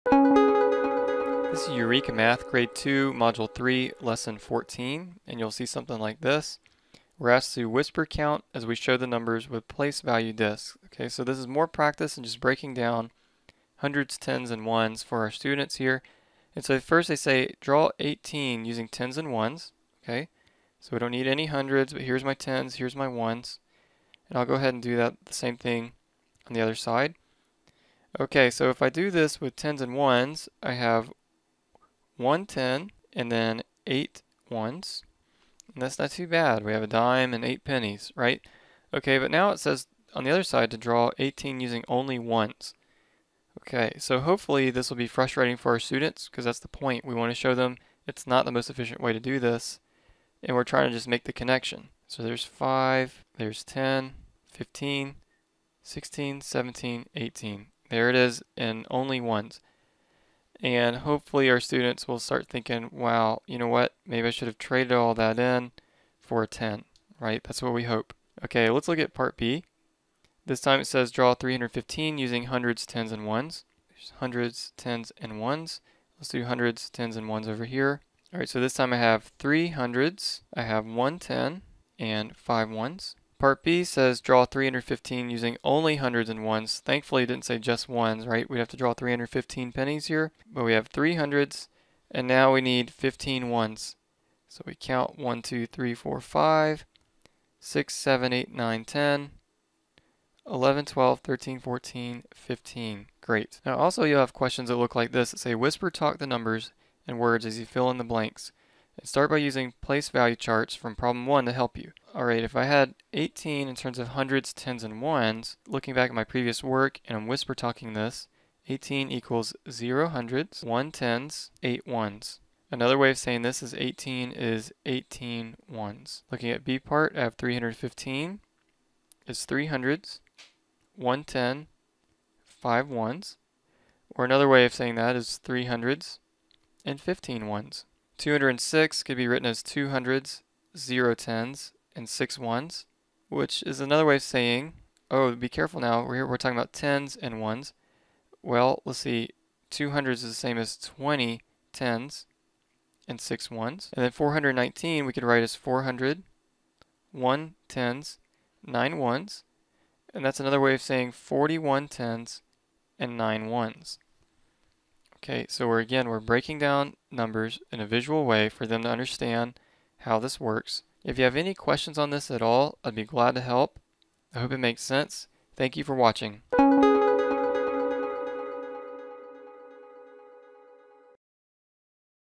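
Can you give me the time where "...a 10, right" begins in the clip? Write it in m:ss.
1:06.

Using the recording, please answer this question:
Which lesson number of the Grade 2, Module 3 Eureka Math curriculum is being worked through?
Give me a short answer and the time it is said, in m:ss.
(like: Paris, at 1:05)
14, at 0:03.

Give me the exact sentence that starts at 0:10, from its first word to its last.
Okay, so this is more practice in just breaking down hundreds, tens, and ones for our students here.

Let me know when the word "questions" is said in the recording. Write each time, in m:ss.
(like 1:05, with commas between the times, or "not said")
1:44, 2:51.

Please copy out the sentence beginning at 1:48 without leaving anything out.
And start by using place value charts from problem 1 to help you.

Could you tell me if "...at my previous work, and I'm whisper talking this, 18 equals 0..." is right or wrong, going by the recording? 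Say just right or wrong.
right.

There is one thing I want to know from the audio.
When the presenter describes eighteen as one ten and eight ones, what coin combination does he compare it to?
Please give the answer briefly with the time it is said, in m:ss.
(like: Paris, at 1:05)
a dime and eight pennies, at 0:36.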